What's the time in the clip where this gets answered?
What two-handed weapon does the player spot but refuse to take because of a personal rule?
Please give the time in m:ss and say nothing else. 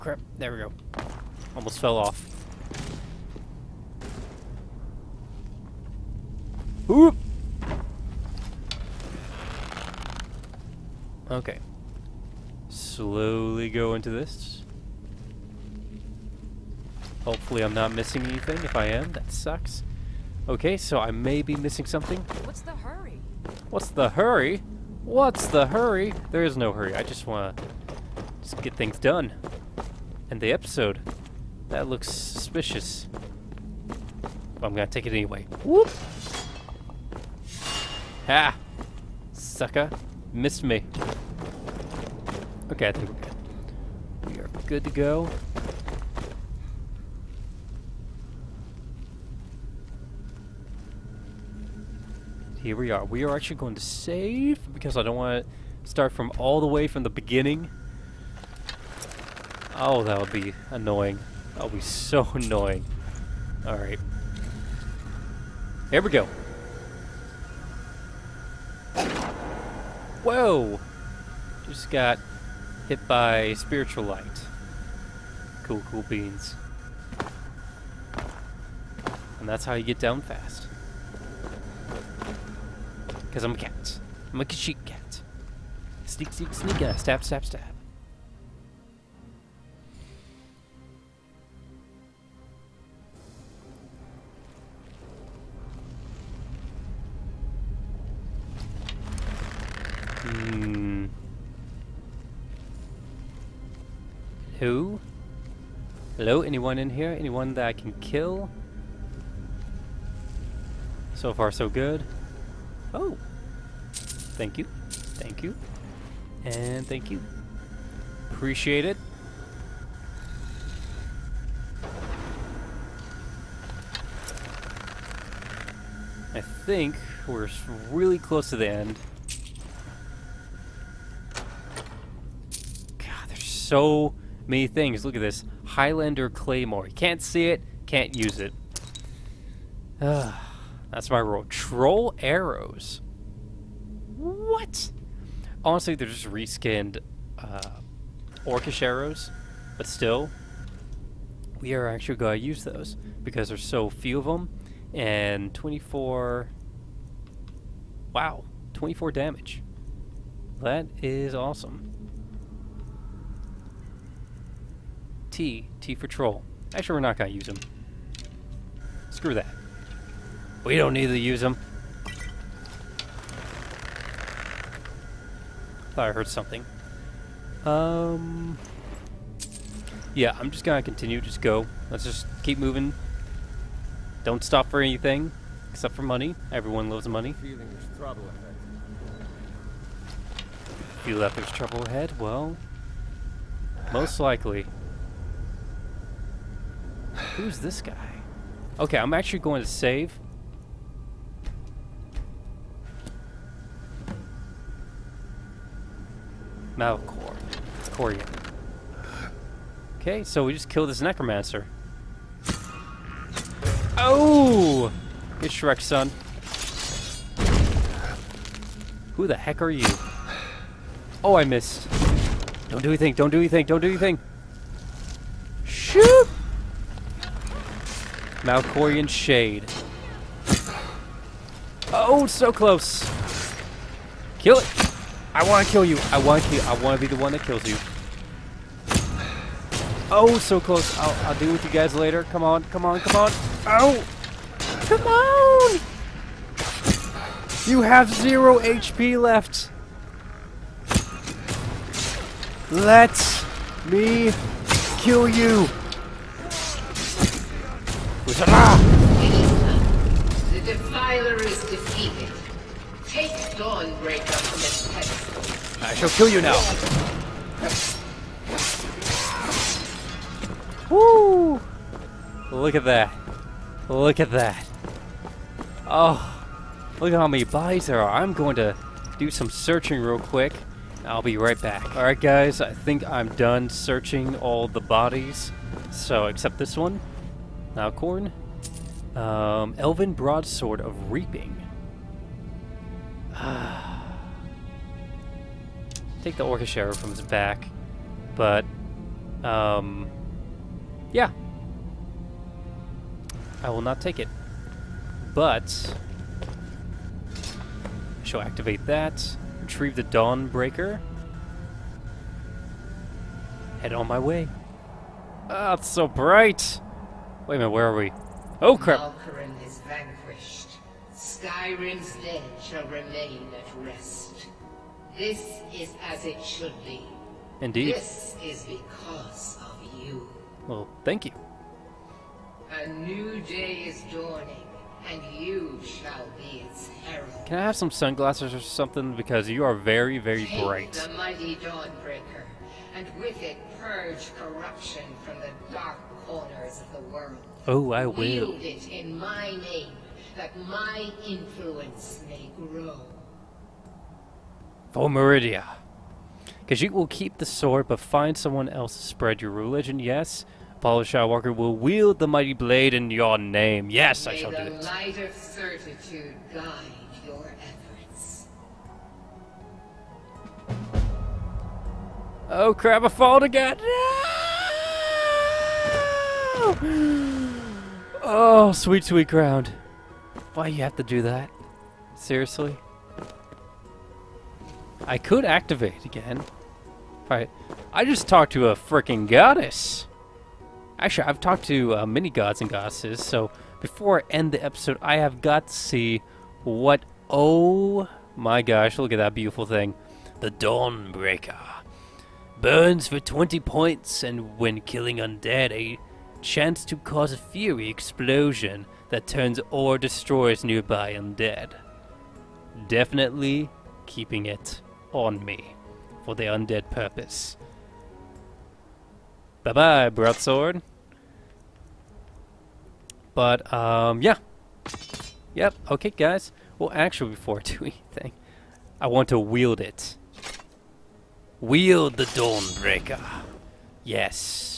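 2:15.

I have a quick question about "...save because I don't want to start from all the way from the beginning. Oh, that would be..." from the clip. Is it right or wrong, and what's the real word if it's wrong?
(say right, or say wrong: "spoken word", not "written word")
right.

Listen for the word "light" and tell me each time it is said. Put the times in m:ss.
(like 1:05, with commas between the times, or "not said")
1:14, 6:04.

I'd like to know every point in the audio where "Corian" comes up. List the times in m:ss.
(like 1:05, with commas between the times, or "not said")
3:27.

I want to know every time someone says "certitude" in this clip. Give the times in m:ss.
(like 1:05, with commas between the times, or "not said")
6:05.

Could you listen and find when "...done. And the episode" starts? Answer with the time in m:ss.
0:28.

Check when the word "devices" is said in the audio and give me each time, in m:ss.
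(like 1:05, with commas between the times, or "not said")
not said.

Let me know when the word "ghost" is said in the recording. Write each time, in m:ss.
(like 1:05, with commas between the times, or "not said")
not said.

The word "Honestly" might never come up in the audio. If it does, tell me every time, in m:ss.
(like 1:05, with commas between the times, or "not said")
2:25.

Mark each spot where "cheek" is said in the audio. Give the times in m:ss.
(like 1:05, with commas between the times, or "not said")
1:24.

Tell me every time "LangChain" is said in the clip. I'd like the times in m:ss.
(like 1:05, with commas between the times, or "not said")
not said.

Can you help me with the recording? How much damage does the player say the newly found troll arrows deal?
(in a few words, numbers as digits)
24.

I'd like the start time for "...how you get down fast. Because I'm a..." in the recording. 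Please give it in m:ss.
1:19.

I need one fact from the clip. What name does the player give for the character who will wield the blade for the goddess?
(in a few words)
Apollo Skywalker.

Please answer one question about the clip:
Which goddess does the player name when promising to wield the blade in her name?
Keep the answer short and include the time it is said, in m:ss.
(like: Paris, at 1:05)
Meridia, at 5:55.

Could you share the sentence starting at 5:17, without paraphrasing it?
Wait a minute, where are we?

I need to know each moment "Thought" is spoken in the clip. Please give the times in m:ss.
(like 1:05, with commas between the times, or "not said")
2:55.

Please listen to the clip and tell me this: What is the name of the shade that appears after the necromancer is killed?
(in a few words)
Malkoran's Shade.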